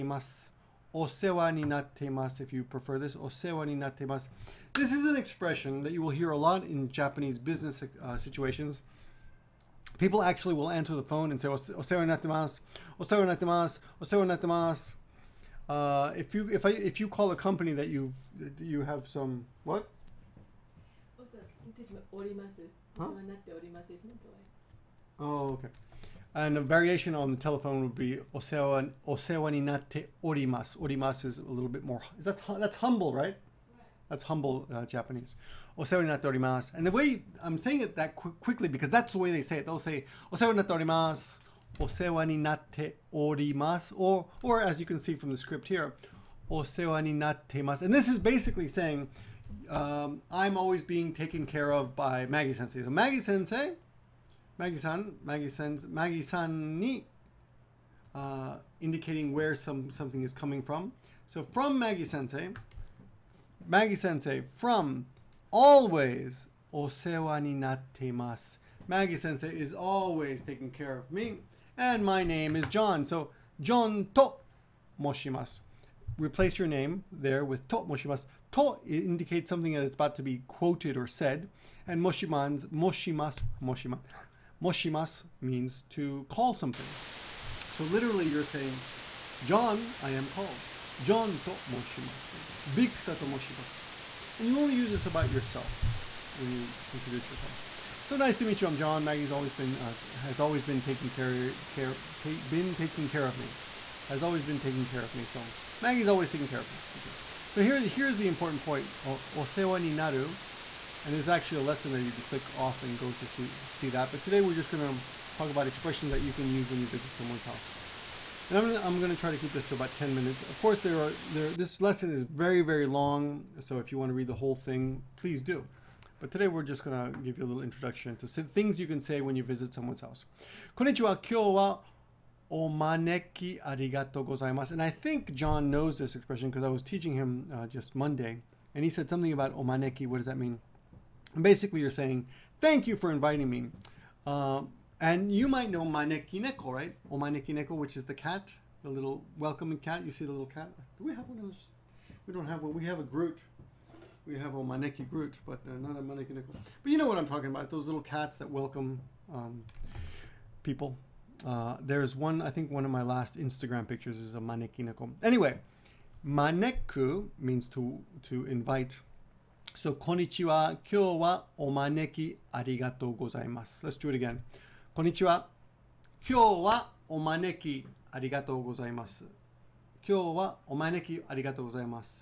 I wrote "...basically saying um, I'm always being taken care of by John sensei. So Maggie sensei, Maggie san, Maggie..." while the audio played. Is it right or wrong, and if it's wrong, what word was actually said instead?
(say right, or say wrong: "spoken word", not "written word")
wrong: "Maggie", not "John".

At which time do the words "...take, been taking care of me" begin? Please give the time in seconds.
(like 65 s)
102 s.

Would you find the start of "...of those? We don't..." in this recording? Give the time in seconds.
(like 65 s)
151 s.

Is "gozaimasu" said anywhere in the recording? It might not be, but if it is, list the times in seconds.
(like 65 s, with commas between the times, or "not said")
134 s, 173 s.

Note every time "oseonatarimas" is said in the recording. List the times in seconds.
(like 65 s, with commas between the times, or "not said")
35 s, 40 s.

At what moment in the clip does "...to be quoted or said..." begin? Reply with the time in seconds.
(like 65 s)
80 s.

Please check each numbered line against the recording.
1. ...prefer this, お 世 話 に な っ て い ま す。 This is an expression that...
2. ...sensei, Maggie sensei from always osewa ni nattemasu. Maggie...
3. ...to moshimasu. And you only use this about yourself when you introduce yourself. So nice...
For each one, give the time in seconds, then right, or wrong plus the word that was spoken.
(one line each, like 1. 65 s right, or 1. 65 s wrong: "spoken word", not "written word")
1. 2 s right
2. 62 s right
3. 93 s right.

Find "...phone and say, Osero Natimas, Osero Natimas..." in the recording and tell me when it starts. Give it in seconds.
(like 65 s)
11 s.